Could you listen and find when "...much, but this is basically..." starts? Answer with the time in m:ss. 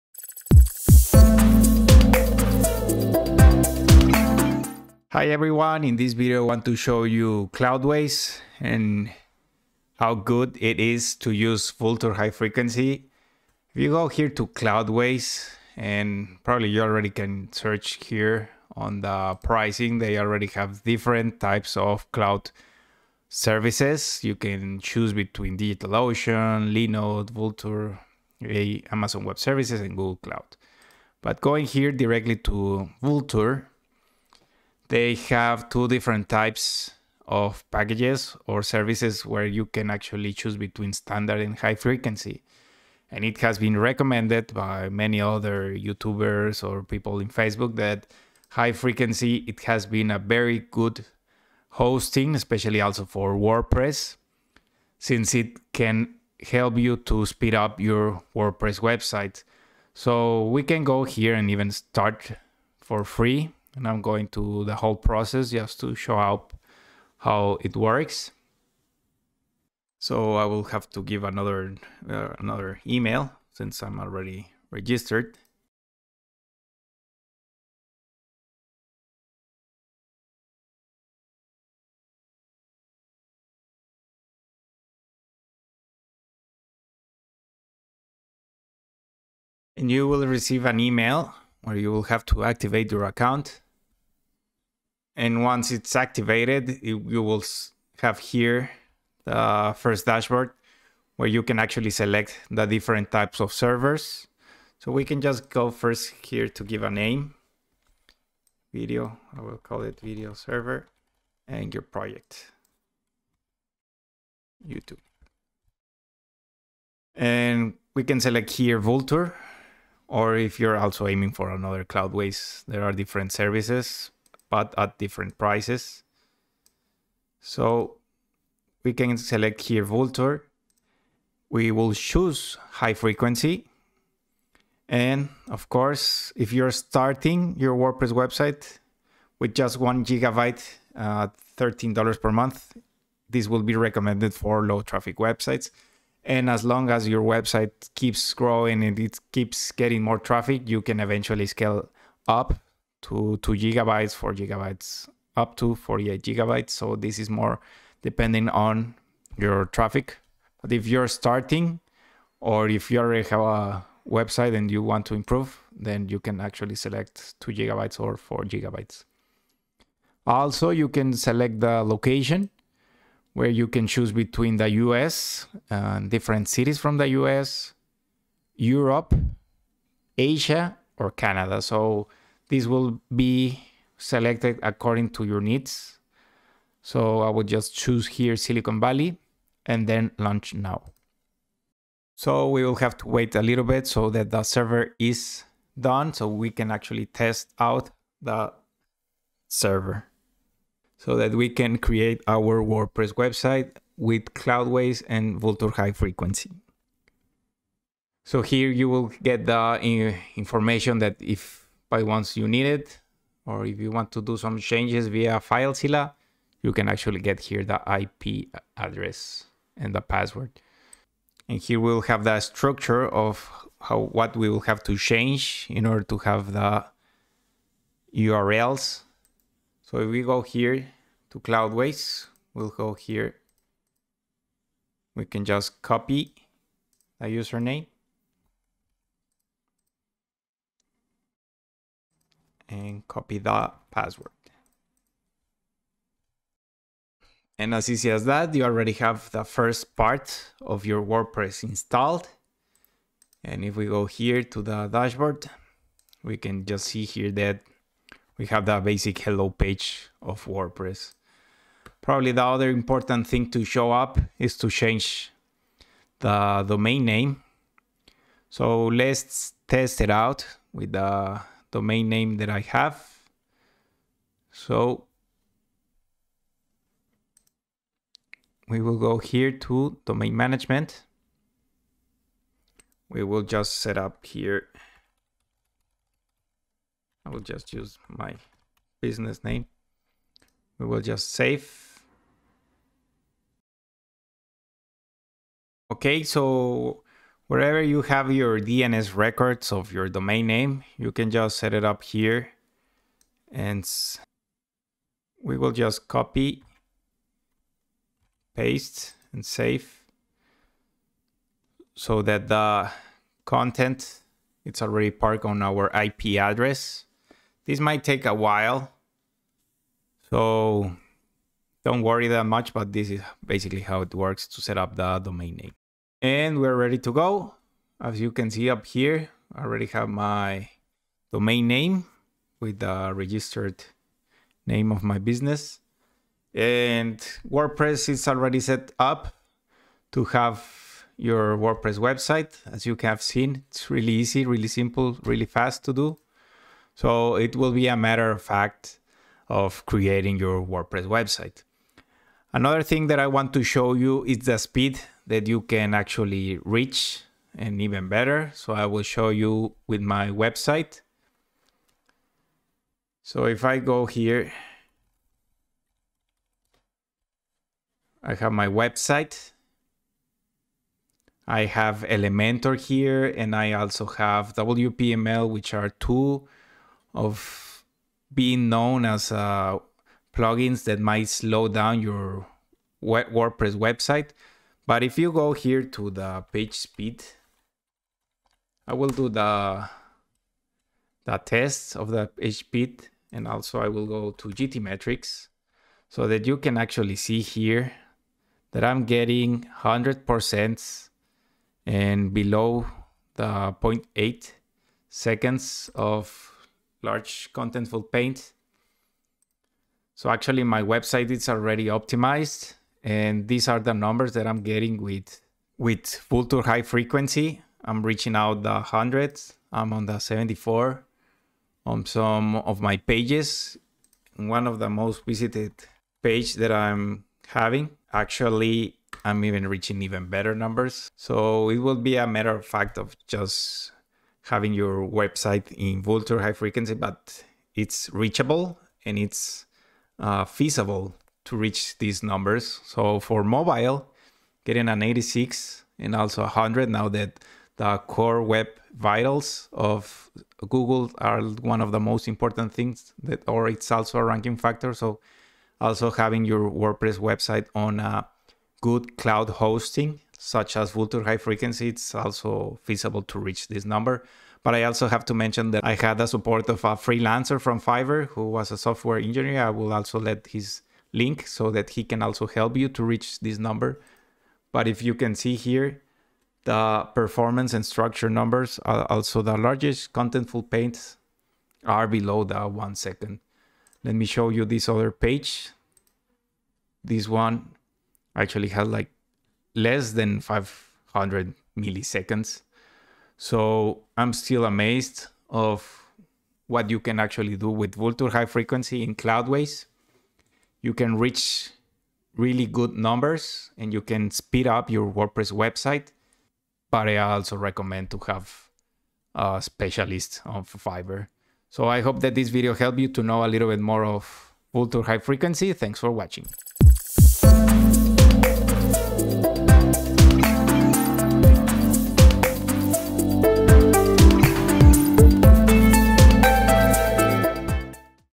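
5:22.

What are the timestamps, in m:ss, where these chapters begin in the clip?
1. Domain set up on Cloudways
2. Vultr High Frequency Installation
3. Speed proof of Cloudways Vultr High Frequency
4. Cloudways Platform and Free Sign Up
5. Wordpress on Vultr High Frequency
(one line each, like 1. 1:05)
1. 4:23
2. 1:34
3. 5:50
4. 0:17
5. 3:48.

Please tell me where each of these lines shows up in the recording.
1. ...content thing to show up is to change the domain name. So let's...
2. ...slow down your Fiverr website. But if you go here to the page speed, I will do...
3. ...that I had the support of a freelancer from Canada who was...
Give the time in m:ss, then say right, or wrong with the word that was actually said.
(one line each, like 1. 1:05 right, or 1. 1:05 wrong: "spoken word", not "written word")
1. 4:22 wrong: "important", not "content"
2. 6:21 wrong: "WordPress", not "Fiverr"
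3. 7:45 wrong: "Fiverr", not "Canada".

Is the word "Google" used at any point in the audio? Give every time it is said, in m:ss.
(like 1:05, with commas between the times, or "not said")
0:29, 7:30.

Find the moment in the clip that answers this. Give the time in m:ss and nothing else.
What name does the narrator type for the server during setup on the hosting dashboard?
1:54.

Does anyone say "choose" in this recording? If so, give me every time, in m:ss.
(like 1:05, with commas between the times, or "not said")
0:24, 0:40, 2:11, 2:53, 3:07.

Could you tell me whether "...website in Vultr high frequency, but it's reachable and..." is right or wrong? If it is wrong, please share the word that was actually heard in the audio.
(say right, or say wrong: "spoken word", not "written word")
right.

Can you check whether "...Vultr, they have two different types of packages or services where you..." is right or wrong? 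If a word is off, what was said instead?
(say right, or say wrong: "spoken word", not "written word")
right.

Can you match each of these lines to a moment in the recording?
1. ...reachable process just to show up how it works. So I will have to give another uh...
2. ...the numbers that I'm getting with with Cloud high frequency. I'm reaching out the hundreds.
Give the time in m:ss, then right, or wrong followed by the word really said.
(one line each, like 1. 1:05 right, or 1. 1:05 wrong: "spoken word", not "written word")
1. 1:04 wrong: "whole", not "reachable"
2. 6:53 wrong: "Vultr", not "Cloud".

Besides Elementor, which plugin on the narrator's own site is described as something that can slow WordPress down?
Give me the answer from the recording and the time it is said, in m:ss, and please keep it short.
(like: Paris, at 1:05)
WPML, at 6:14.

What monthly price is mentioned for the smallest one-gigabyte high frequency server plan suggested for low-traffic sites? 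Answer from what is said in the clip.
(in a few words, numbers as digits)
$13.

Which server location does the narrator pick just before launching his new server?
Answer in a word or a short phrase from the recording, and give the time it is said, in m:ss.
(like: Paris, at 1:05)
Silicon Valley, at 3:08.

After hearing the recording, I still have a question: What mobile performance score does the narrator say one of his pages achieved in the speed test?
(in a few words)
86.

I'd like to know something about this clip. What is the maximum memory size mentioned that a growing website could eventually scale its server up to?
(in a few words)
48 gigabytes.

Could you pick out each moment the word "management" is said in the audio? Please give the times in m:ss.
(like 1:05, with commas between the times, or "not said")
4:40.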